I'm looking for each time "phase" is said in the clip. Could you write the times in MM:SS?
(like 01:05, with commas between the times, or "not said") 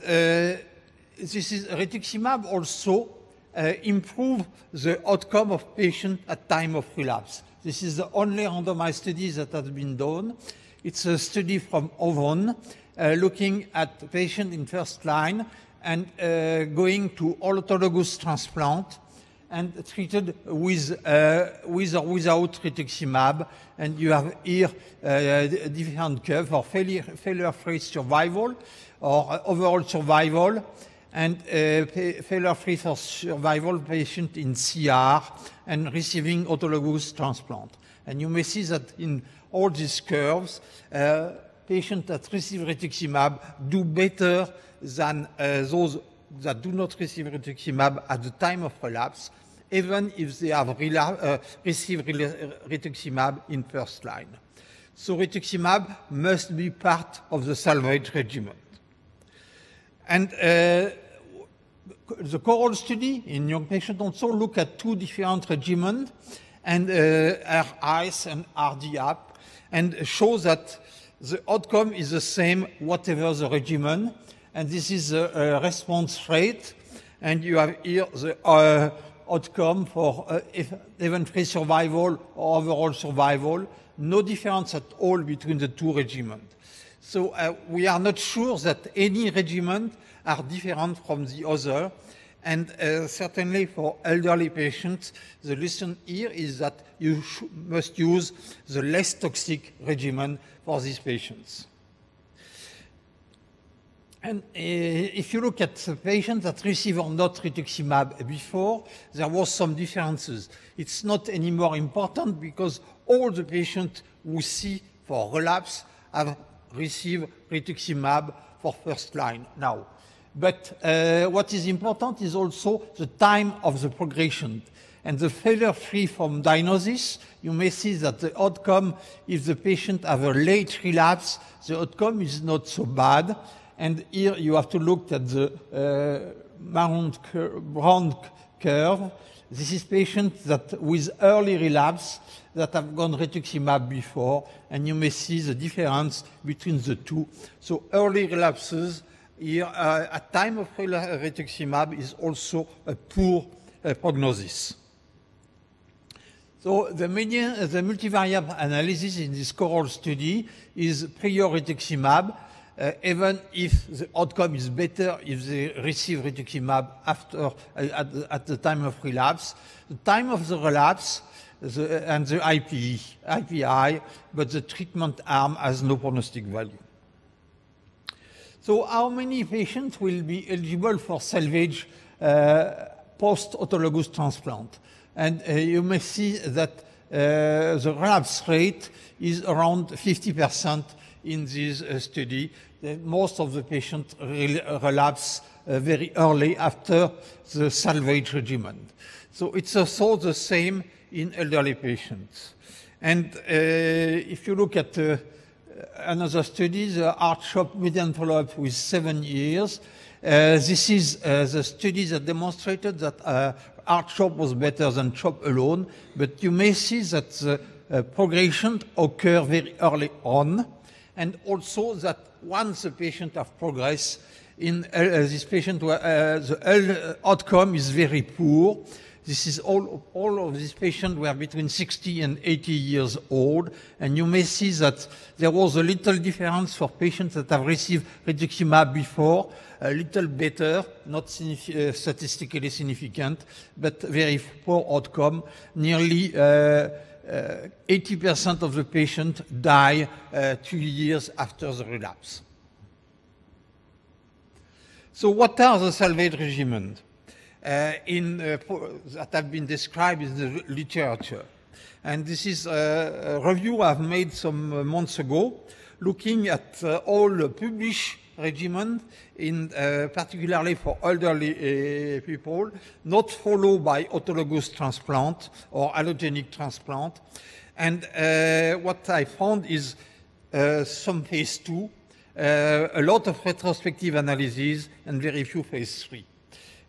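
04:41, 04:45.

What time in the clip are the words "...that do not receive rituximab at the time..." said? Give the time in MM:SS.
00:46.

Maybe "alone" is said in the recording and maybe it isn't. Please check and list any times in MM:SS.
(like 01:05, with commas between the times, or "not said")
03:35.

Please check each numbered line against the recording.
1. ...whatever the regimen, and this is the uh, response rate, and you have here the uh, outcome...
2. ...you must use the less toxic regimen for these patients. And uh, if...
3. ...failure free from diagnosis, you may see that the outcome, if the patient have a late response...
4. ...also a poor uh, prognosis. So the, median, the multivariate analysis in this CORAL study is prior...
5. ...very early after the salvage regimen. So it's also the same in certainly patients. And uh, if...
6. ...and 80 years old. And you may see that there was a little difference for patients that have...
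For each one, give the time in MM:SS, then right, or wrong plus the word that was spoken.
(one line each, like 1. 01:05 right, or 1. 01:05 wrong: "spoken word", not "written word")
1. 01:12 right
2. 01:36 right
3. 02:05 wrong: "relapse", not "response"
4. 02:32 right
5. 03:15 wrong: "elderly", not "certainly"
6. 03:52 right.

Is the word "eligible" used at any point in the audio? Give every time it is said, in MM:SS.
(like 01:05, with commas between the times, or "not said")
03:00.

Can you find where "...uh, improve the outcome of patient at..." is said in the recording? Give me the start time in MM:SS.
00:03.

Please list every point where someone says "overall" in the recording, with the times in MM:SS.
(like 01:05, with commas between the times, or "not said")
00:29, 01:22.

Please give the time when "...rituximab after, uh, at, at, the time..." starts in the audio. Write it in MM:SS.
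02:46.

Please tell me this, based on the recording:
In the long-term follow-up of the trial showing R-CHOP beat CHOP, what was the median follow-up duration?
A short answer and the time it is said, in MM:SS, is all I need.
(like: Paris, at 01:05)
7 years, at 03:28.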